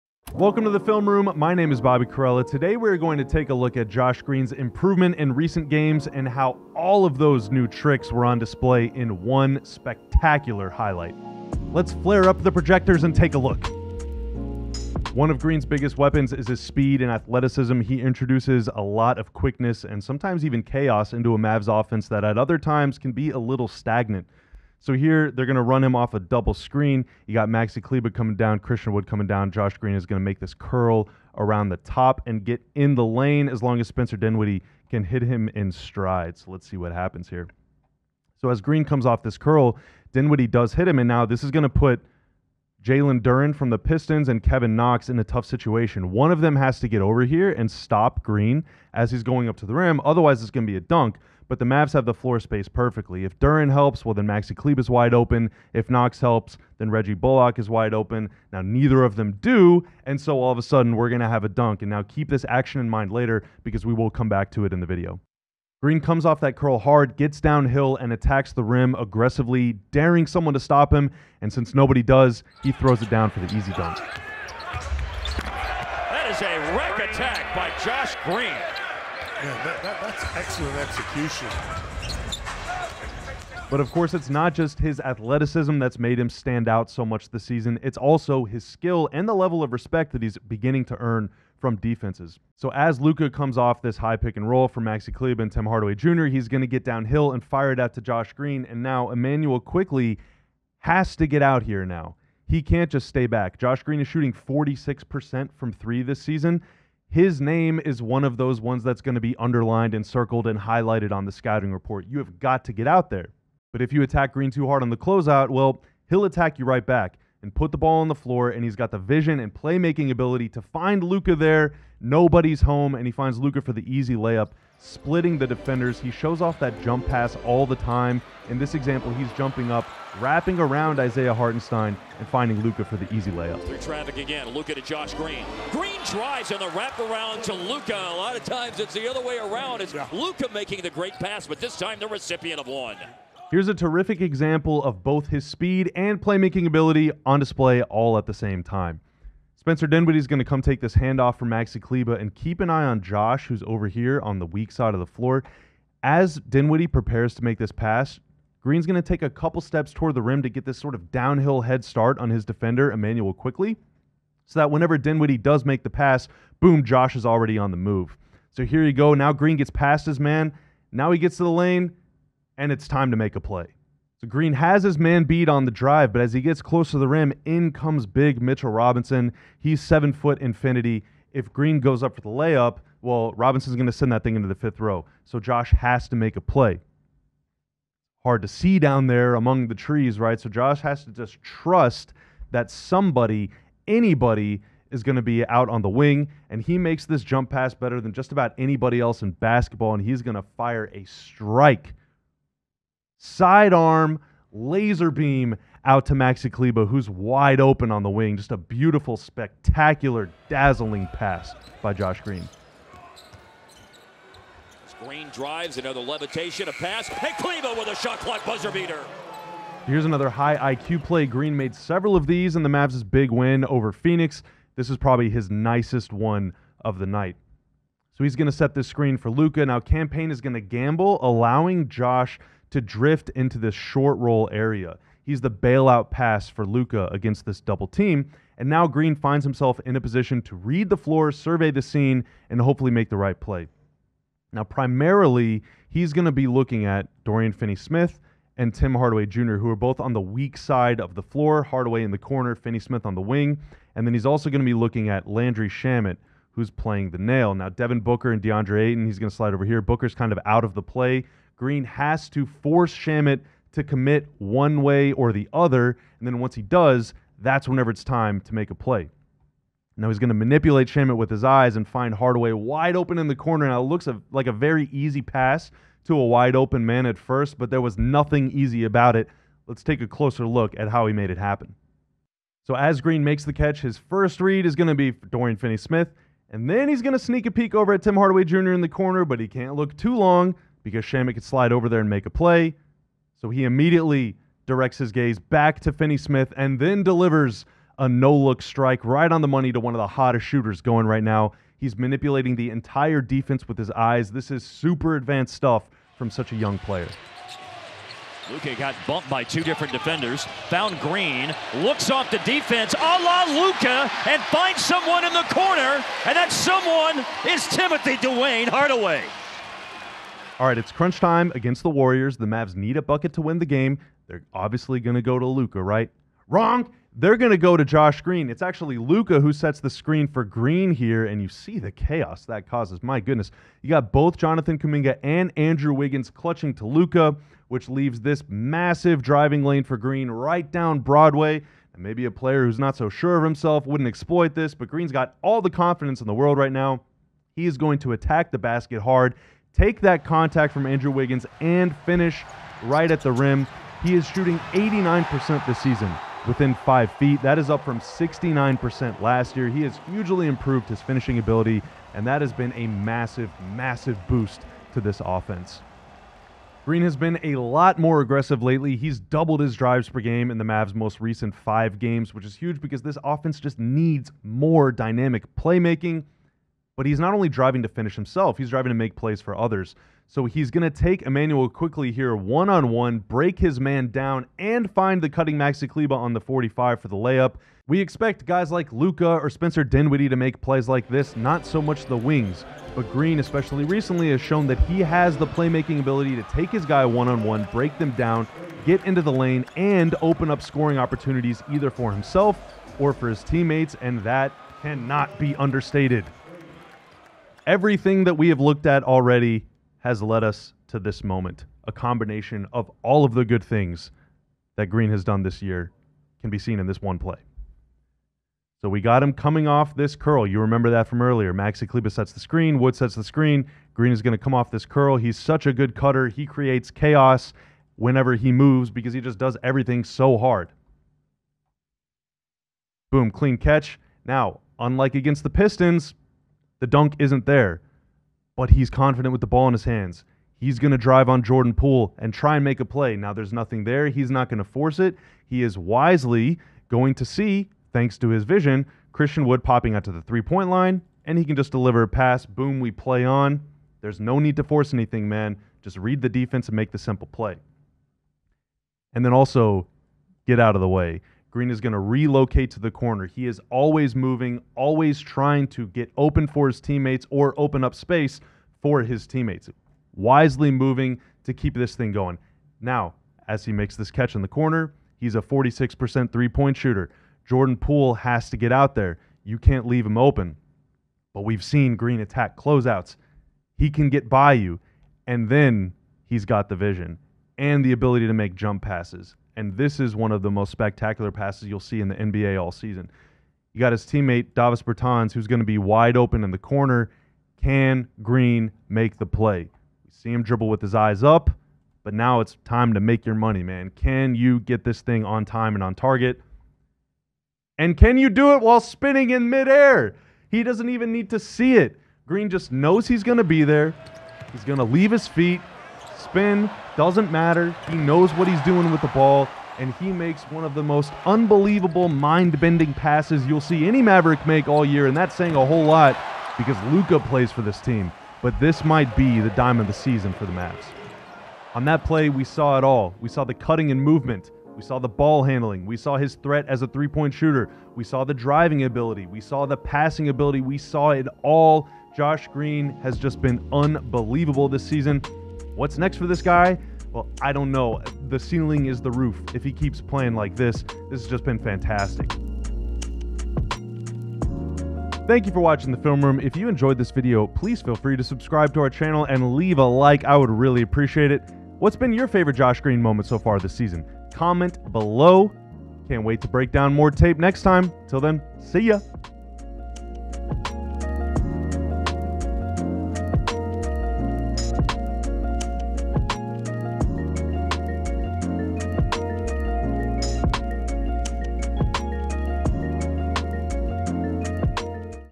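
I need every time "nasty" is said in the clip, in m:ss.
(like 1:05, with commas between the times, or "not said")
not said.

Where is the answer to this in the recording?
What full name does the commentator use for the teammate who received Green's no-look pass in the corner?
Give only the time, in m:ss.
5:17.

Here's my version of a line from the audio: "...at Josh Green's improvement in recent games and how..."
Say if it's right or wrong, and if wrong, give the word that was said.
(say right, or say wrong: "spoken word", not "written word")
right.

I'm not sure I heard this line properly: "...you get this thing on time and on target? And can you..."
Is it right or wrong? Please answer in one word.
right.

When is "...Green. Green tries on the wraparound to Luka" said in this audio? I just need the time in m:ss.
2:15.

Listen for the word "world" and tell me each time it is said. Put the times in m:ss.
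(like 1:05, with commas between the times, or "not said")
5:46.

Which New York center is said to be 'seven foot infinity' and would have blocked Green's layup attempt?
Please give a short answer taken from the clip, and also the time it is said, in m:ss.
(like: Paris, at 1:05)
Mitchell Robinson, at 2:58.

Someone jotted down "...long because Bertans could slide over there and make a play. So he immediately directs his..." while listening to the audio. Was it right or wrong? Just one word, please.
wrong.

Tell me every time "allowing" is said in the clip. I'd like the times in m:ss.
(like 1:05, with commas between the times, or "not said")
3:51.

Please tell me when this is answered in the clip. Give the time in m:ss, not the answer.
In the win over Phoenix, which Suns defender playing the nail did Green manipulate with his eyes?
4:15.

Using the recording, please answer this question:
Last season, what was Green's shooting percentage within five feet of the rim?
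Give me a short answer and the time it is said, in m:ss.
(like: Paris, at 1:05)
69%, at 5:57.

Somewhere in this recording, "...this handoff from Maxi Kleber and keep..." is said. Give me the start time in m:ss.
2:30.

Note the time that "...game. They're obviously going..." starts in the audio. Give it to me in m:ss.
5:23.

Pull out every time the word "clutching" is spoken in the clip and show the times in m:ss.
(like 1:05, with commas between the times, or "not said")
5:36.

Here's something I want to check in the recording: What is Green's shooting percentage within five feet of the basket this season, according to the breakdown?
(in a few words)
89%.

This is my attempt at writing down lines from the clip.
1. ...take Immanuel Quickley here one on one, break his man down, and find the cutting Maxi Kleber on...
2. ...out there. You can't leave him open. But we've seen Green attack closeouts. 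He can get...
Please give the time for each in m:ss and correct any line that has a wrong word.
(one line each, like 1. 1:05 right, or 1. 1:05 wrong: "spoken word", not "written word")
1. 6:20 right
2. 7:58 right.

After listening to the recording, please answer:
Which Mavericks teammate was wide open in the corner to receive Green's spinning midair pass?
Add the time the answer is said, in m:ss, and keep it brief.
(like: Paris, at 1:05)
Davis Bertans, at 8:14.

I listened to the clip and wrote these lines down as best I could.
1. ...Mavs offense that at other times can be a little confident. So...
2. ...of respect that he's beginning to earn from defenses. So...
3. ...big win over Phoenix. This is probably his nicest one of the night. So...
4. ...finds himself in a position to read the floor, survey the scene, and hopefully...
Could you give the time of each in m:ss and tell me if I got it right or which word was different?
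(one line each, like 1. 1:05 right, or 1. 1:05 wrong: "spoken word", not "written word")
1. 0:21 wrong: "stagnant", not "confident"
2. 1:29 right
3. 3:43 right
4. 3:59 right.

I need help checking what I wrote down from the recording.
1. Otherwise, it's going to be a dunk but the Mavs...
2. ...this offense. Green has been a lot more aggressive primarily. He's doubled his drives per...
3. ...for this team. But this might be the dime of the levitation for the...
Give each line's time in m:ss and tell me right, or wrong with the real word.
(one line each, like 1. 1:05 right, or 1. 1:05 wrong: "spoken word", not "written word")
1. 0:50 right
2. 6:05 wrong: "lately", not "primarily"
3. 8:47 wrong: "season", not "levitation".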